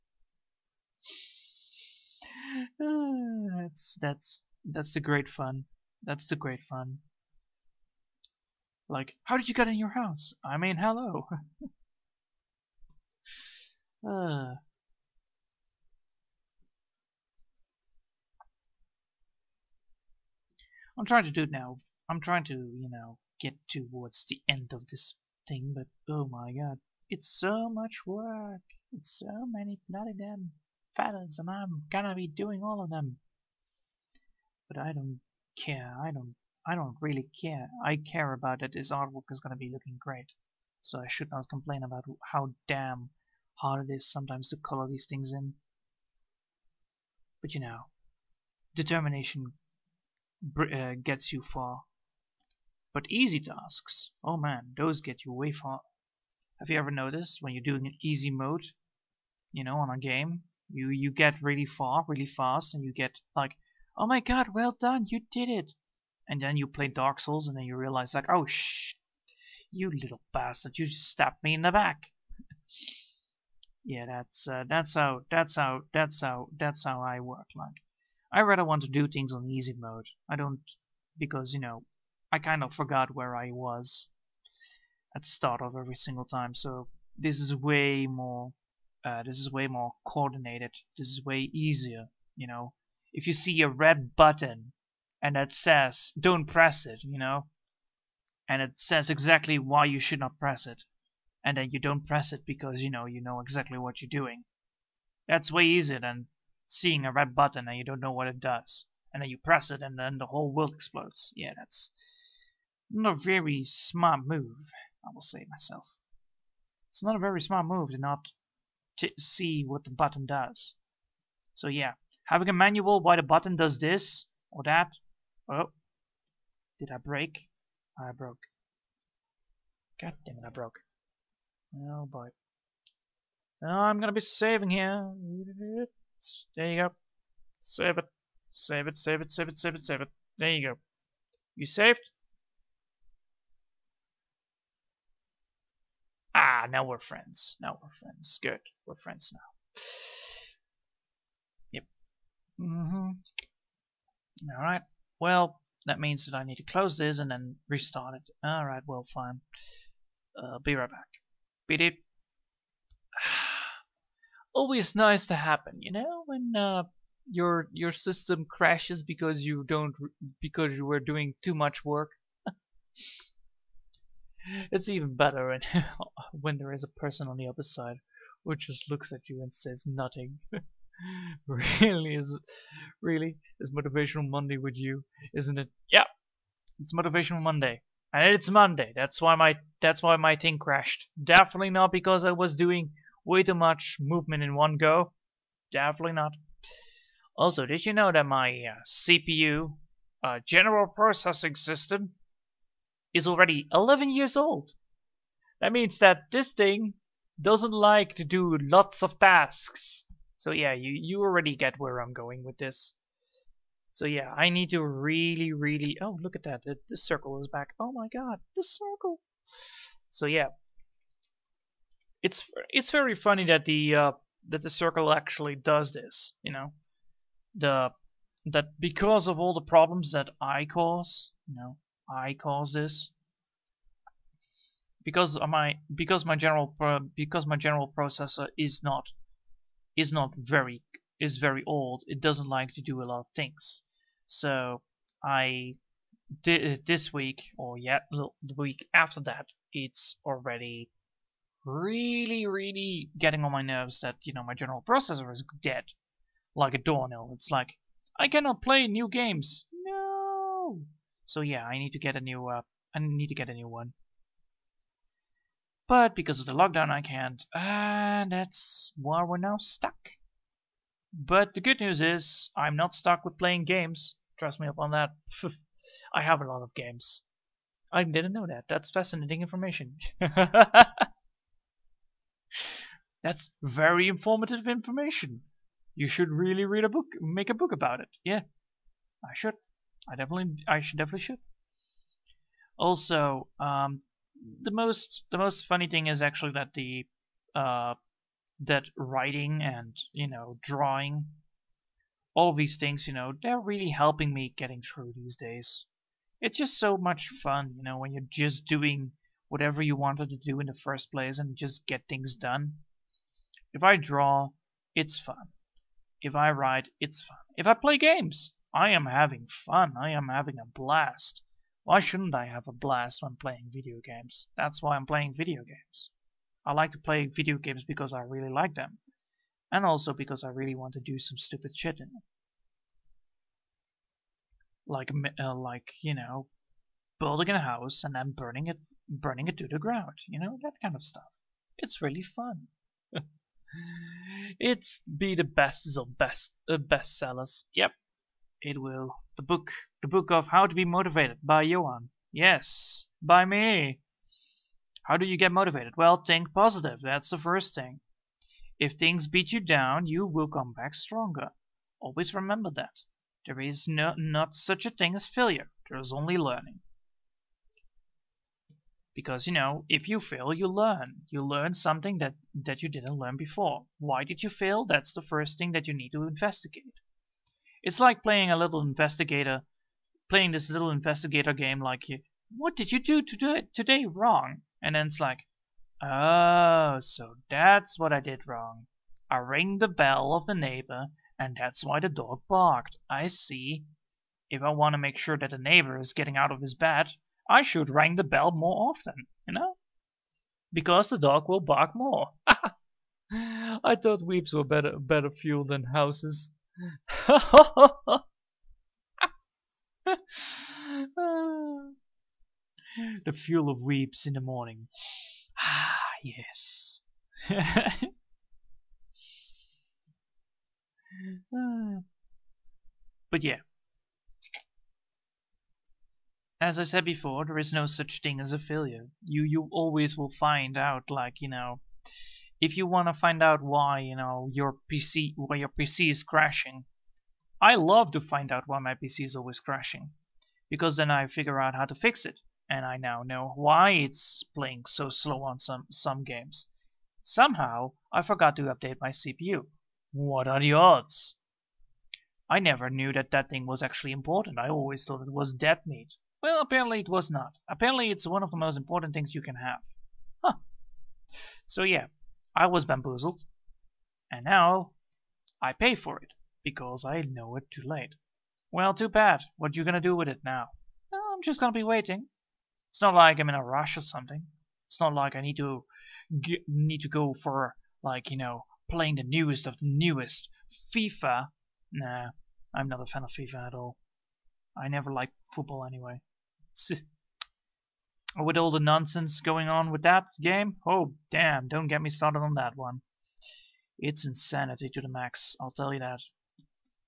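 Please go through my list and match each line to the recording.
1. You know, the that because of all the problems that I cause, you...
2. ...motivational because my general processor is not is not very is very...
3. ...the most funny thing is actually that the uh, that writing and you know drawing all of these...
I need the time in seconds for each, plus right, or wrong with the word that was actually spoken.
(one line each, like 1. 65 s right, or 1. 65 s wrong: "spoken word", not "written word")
1. 226 s right
2. 236 s wrong: "general", not "motivational"
3. 295 s right.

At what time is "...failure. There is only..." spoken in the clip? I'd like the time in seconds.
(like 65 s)
365 s.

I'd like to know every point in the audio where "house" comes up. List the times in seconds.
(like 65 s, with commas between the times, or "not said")
9 s, 337 s, 405 s.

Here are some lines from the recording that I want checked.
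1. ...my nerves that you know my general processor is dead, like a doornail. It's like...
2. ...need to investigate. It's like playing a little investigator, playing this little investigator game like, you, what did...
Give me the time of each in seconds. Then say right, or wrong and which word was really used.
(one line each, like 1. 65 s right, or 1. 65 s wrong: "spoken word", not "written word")
1. 253 s right
2. 375 s right.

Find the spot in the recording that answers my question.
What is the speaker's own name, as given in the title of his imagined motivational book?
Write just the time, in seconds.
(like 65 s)
351 s.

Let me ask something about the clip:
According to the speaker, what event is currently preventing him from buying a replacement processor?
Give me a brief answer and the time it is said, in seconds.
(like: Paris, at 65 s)
The lockdown, at 266 s.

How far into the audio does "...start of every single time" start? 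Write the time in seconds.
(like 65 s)
85 s.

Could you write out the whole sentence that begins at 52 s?
But easy tasks, oh man, those get you way far.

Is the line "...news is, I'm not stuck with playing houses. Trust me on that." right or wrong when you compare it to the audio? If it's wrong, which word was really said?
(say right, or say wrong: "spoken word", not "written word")
wrong: "games", not "houses".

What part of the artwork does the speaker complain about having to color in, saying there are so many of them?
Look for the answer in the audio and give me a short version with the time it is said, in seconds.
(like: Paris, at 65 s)
Feathers, at 30 s.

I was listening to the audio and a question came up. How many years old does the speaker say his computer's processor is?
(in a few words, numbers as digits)
11.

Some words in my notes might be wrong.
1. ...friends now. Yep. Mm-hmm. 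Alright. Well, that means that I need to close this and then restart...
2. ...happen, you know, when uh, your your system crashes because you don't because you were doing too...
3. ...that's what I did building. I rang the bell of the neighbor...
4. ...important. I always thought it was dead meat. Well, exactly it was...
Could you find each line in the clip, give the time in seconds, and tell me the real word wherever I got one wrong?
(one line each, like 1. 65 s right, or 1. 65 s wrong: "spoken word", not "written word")
1. 148 s right
2. 165 s right
3. 387 s wrong: "wrong", not "building"
4. 454 s wrong: "apparently", not "exactly".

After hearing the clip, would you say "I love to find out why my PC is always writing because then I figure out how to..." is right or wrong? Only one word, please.
wrong.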